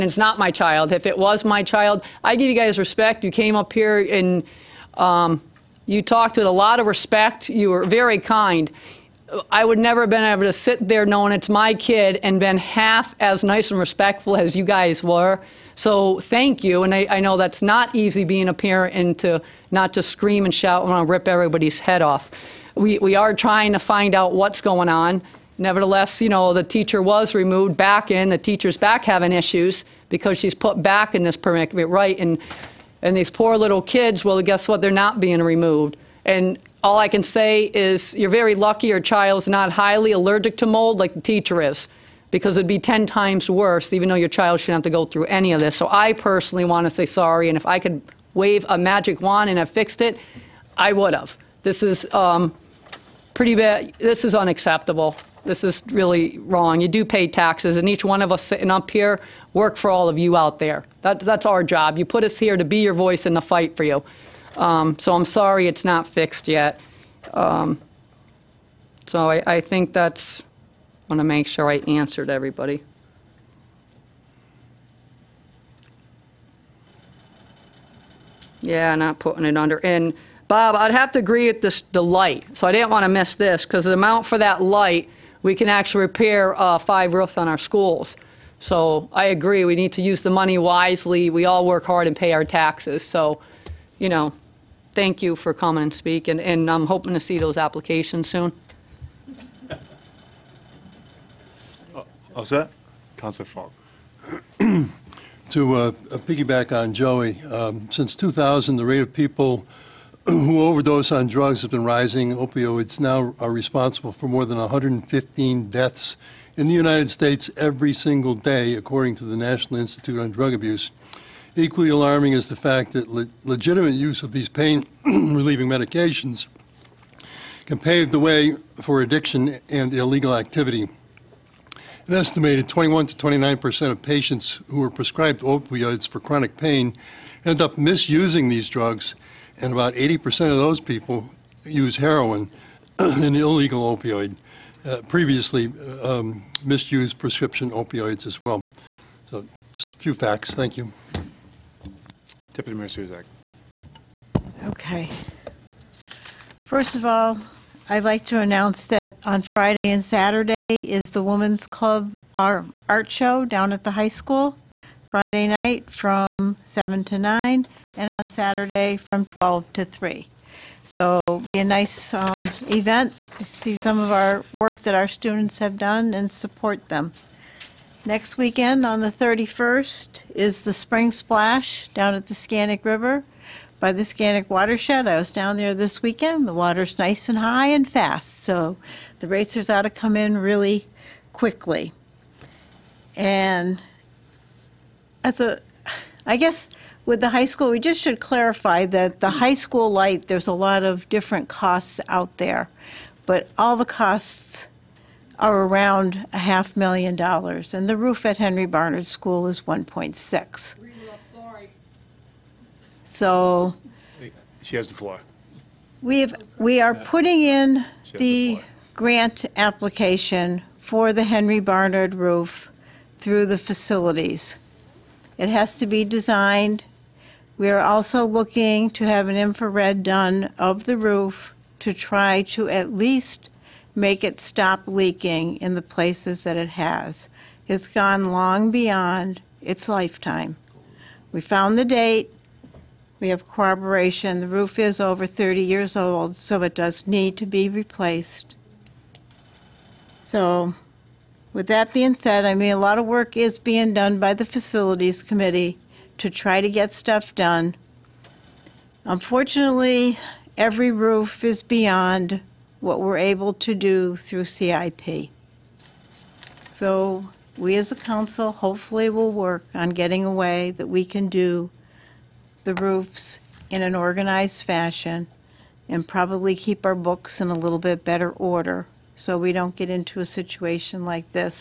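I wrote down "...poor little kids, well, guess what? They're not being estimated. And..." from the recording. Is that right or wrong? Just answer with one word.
wrong.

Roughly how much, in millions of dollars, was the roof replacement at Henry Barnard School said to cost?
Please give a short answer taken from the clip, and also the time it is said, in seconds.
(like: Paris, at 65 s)
1.6 million, at 209 s.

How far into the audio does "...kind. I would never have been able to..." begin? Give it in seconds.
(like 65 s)
8 s.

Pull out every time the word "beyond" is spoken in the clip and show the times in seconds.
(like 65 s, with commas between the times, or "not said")
238 s, 261 s.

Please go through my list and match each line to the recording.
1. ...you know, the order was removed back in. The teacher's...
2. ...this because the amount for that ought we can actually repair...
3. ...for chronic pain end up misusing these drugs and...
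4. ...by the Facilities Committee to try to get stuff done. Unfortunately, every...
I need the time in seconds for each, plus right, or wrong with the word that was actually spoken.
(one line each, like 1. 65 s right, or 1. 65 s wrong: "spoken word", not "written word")
1. 26 s wrong: "teacher", not "order"
2. 83 s wrong: "light", not "ought"
3. 136 s right
4. 254 s right.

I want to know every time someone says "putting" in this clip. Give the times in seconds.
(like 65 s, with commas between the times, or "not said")
79 s, 216 s.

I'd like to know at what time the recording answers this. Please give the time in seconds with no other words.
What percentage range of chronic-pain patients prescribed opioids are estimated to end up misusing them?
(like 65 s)
132 s.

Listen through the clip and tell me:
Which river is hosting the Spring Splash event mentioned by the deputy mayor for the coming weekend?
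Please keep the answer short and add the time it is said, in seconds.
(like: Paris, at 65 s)
Scantic River, at 182 s.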